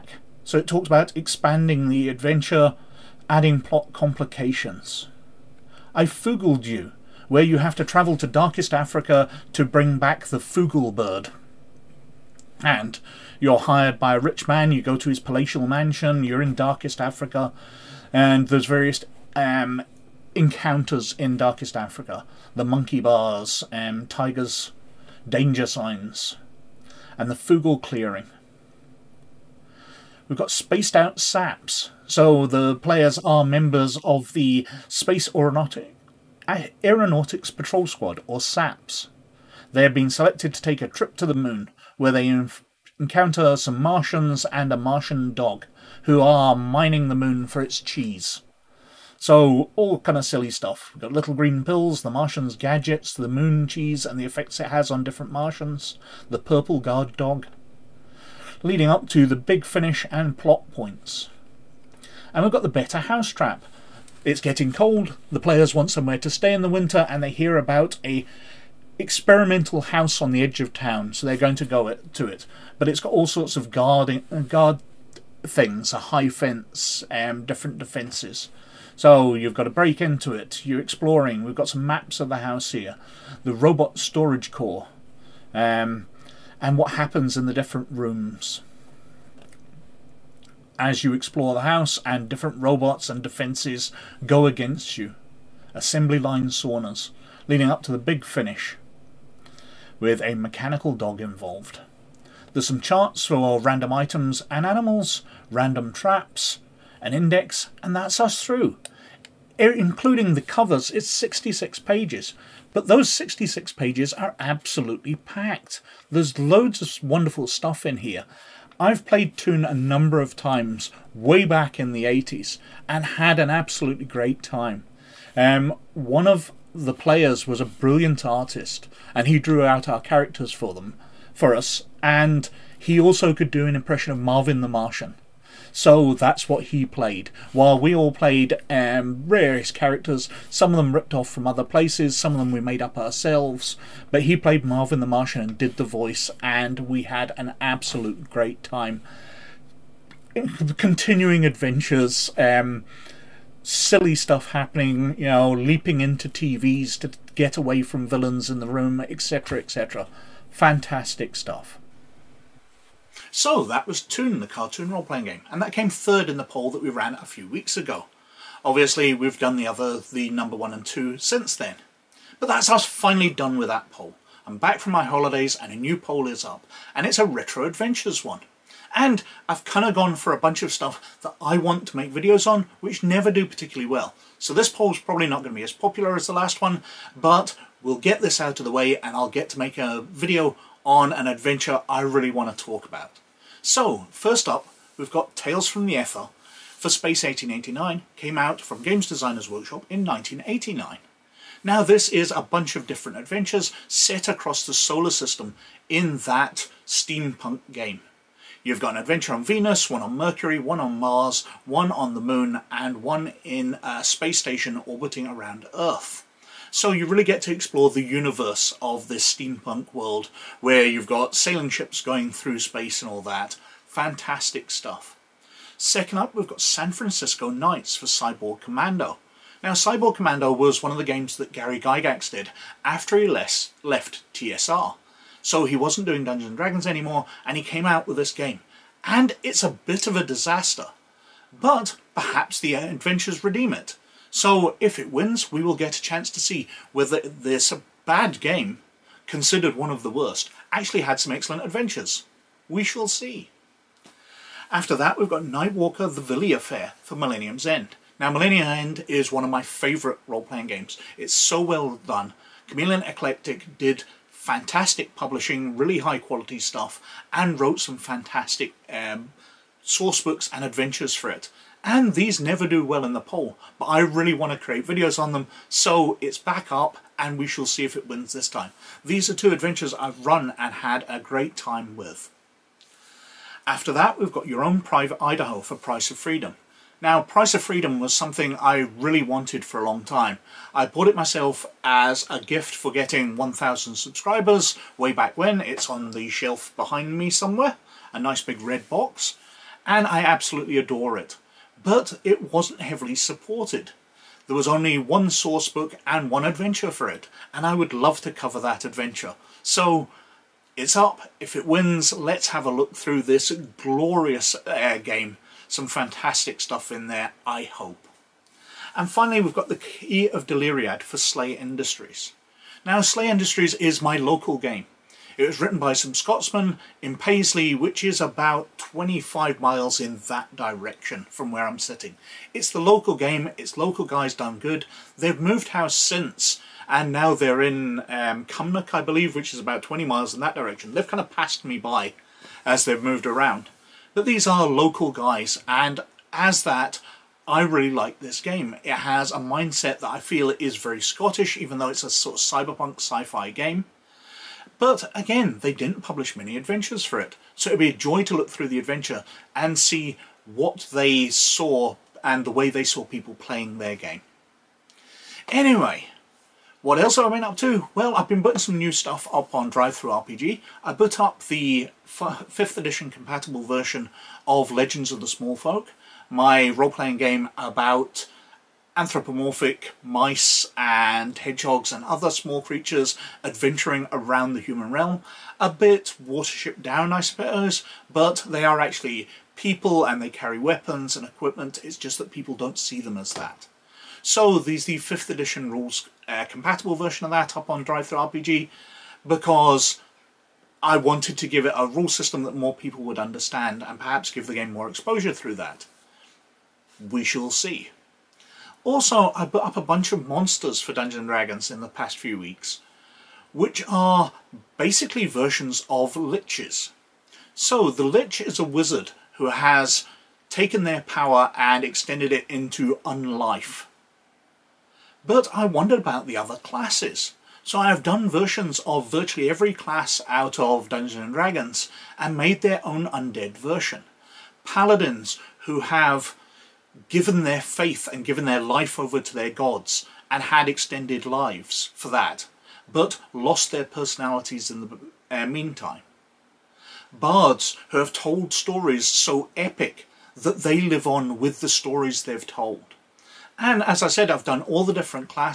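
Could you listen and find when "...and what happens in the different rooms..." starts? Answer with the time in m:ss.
1:26.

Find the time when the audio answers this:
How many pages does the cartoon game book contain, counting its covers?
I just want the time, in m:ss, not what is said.
1:50.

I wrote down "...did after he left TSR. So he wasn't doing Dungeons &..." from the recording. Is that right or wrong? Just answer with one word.
right.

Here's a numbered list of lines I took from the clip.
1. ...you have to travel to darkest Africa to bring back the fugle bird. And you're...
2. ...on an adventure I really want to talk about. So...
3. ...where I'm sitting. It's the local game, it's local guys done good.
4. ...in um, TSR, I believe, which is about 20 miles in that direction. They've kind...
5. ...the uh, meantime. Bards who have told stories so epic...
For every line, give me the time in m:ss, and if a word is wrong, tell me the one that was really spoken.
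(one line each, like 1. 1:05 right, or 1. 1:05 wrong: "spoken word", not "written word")
1. 0:07 right
2. 3:10 right
3. 5:31 right
4. 5:37 wrong: "Cumnock", not "TSR"
5. 7:24 right.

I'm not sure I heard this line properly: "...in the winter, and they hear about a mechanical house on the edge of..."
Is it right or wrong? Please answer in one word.
wrong.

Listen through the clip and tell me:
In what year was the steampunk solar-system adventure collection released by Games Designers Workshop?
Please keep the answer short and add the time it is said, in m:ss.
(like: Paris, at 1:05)
1989, at 3:20.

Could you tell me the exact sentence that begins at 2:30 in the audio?
Continuing adventures, um, silly stuff happening, you know, leaping into TVs to get away from villains in the room, etc., etc.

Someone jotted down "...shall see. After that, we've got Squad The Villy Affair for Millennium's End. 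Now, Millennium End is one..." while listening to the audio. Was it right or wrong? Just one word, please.
wrong.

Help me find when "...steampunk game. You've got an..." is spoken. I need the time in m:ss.
3:26.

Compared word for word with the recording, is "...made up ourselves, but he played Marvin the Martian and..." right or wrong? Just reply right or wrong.
right.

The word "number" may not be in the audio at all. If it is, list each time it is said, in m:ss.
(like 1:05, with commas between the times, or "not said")
1:59, 2:50.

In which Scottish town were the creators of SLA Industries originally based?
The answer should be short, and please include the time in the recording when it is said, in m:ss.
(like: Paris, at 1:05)
Paisley, at 5:27.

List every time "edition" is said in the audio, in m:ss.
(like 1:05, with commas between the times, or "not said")
6:12, 6:35.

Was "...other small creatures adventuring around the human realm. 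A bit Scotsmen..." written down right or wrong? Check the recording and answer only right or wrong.
wrong.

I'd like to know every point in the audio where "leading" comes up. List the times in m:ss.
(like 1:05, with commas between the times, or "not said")
0:58, 1:37.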